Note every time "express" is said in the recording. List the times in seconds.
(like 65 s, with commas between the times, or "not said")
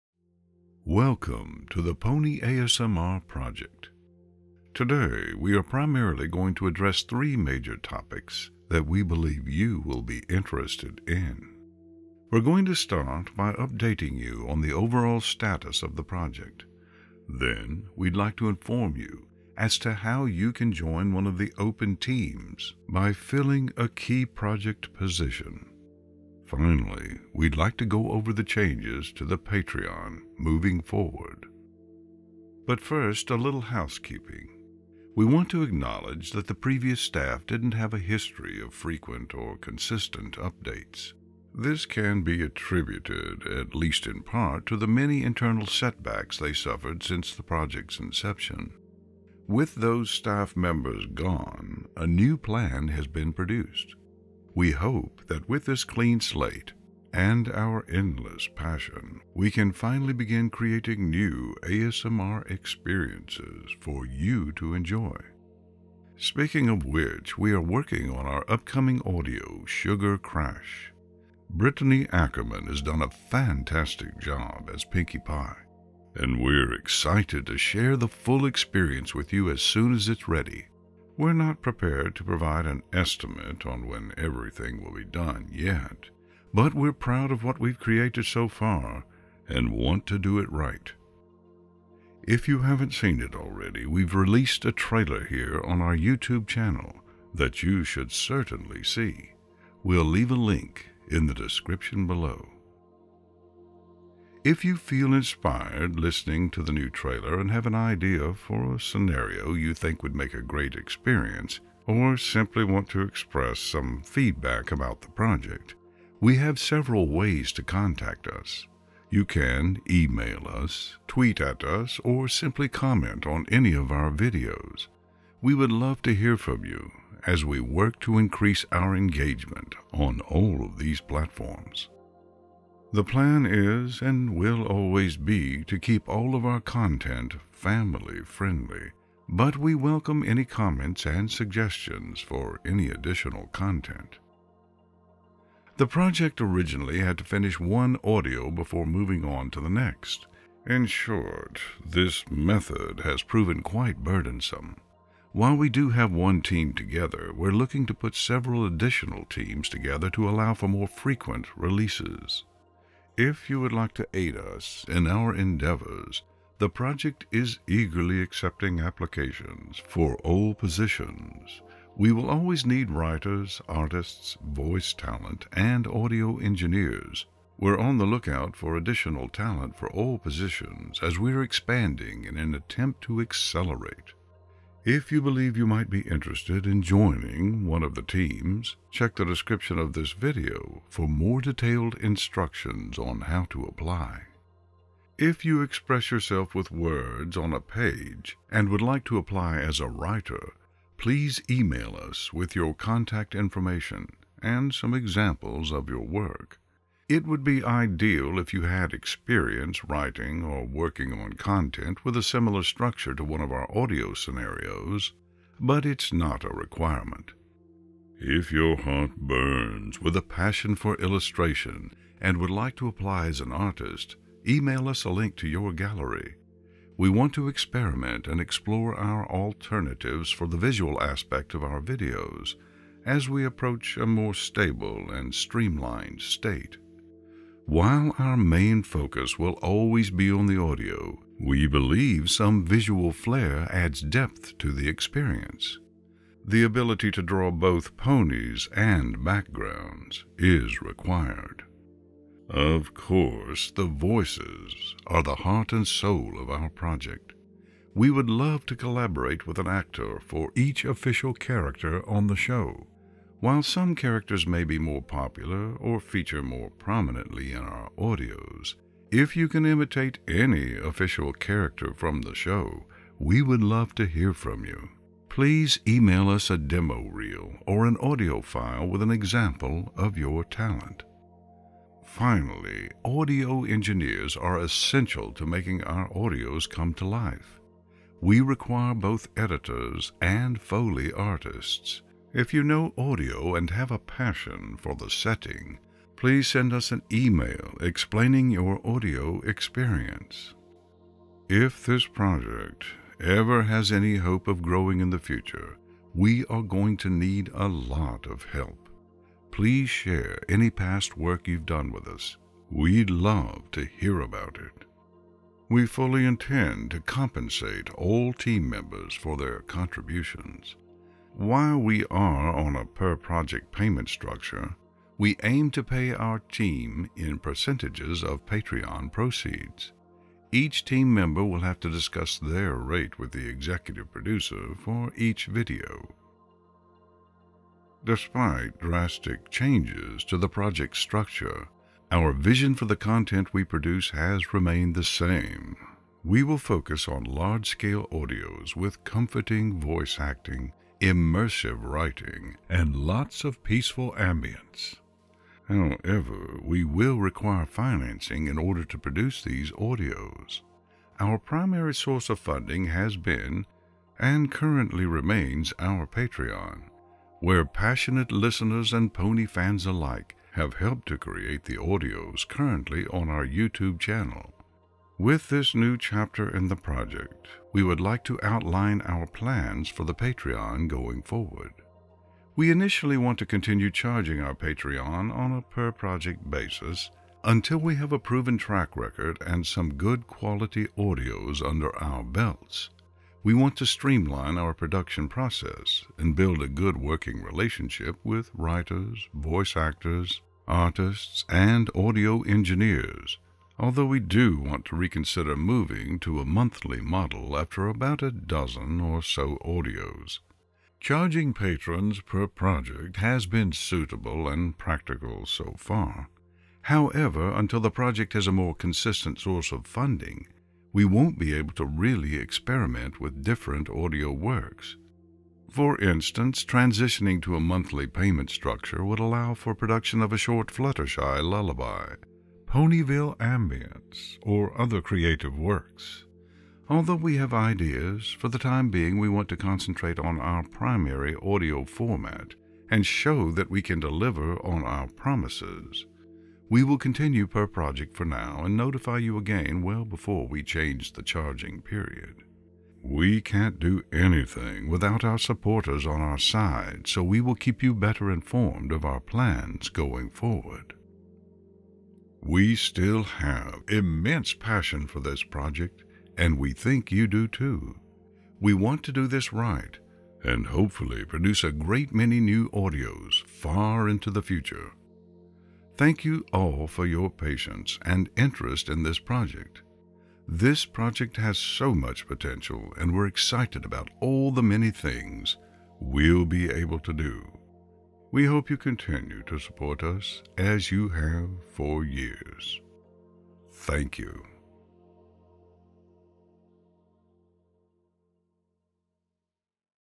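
113 s, 195 s.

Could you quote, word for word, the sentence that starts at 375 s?
With this new chapter in the project, we would like to outline our plans for the Patreon going forward.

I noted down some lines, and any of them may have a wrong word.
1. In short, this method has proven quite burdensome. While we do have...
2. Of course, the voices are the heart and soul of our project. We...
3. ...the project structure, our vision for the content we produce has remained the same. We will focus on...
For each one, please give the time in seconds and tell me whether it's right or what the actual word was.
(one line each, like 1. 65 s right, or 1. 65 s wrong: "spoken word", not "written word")
1. 150 s right
2. 252 s right
3. 340 s right.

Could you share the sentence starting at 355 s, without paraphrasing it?
However, we will require financing in order to produce these audios.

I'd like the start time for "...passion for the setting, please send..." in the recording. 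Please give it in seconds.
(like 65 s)
293 s.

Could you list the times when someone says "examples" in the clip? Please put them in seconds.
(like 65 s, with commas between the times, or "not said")
204 s, 279 s.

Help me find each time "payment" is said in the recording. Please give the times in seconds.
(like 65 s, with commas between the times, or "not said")
323 s, 428 s.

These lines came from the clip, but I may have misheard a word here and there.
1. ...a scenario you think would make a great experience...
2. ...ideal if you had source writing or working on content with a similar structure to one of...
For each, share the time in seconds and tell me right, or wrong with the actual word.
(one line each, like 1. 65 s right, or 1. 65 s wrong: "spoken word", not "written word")
1. 108 s right
2. 207 s wrong: "experience", not "source".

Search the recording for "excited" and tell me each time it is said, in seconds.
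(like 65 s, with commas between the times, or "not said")
76 s, 483 s.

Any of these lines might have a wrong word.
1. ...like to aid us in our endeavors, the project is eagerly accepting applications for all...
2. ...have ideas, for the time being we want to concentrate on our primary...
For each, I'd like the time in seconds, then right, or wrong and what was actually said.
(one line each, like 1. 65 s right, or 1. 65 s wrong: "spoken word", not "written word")
1. 163 s right
2. 437 s right.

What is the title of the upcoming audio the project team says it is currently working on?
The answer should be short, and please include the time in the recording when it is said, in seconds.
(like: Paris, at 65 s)
Sugar Crash, at 69 s.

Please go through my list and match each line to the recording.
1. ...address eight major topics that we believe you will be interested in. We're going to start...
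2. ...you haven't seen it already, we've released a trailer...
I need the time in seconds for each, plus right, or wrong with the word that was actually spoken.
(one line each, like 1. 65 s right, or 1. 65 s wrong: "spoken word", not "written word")
1. 6 s wrong: "three", not "eight"
2. 92 s right.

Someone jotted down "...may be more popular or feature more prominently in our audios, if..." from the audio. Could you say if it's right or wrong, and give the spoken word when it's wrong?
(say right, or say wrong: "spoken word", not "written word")
right.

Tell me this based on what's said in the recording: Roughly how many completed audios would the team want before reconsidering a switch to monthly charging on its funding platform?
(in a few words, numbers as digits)
About a dozen.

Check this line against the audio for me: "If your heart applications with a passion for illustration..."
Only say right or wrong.
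wrong.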